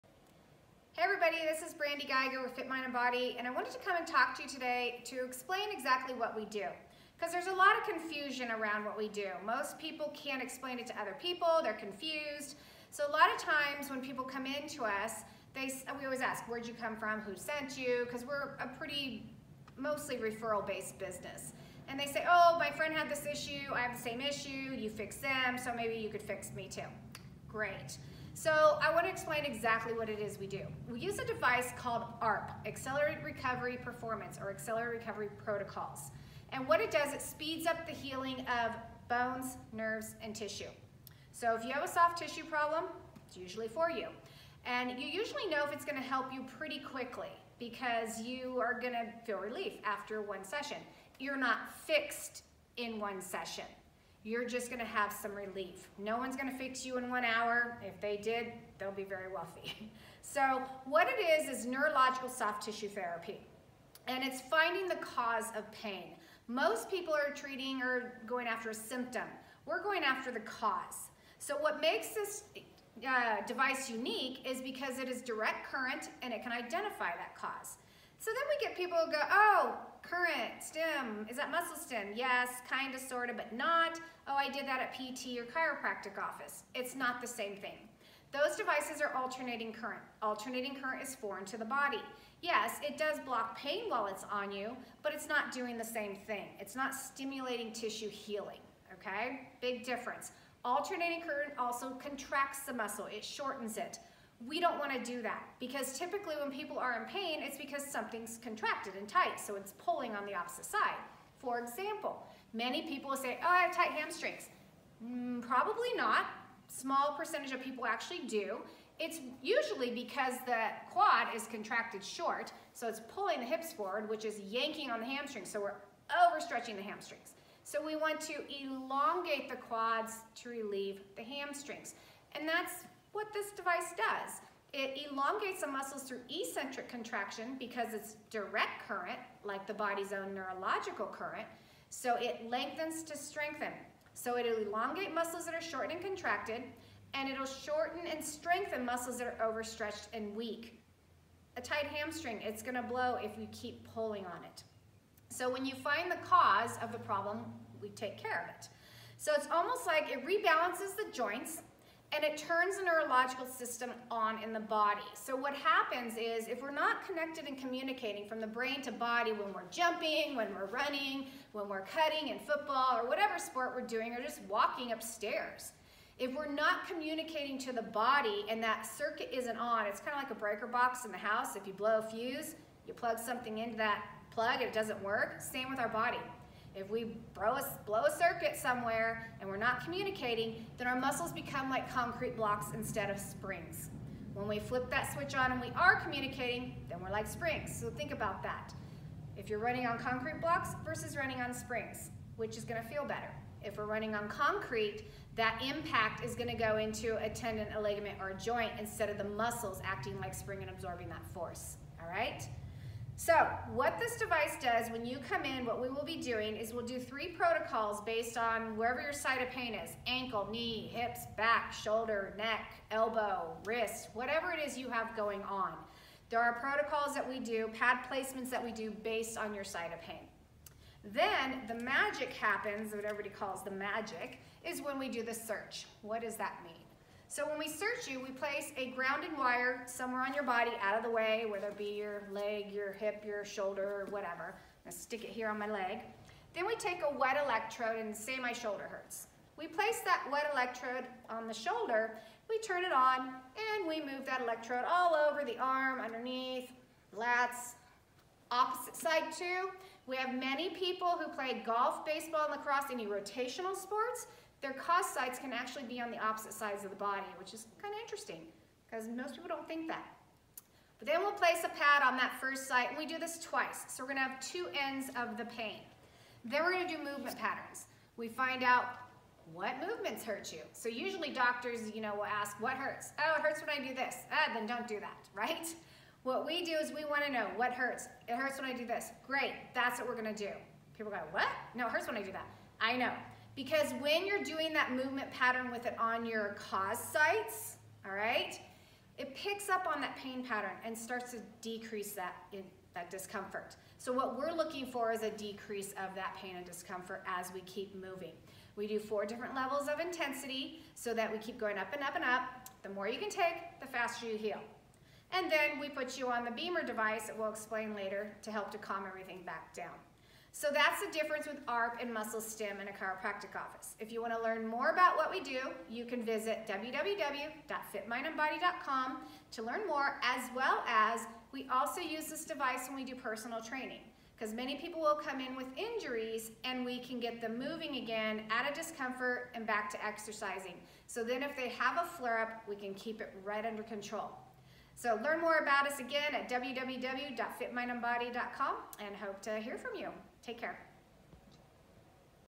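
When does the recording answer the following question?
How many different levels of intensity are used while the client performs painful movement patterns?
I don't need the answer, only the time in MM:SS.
05:08.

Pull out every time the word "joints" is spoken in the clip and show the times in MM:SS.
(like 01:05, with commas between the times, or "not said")
02:41, 03:28.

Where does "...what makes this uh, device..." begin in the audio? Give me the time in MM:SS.
01:11.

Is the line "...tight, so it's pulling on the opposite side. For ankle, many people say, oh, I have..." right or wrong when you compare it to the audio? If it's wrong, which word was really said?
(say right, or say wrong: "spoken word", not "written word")
wrong: "example", not "ankle".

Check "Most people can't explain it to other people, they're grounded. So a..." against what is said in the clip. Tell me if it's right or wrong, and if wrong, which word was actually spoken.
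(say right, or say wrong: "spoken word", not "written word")
wrong: "confused", not "grounded".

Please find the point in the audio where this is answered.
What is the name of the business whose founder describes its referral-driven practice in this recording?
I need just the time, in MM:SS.
00:02.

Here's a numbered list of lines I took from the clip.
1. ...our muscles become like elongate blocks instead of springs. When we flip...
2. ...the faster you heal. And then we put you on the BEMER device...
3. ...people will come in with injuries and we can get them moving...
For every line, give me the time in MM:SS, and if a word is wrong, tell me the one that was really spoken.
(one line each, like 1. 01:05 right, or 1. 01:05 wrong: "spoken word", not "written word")
1. 03:10 wrong: "concrete", not "elongate"
2. 05:13 right
3. 05:34 right.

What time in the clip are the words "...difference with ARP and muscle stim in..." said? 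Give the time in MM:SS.
05:21.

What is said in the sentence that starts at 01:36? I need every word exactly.
It's not stimulating tissue healing, okay?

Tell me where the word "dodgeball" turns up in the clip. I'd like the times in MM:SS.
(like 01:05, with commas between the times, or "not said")
not said.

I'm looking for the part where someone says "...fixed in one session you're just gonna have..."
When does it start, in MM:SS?
00:51.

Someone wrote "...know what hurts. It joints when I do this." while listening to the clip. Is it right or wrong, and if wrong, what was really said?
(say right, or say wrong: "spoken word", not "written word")
wrong: "hurts", not "joints".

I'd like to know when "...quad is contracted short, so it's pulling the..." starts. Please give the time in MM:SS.
02:00.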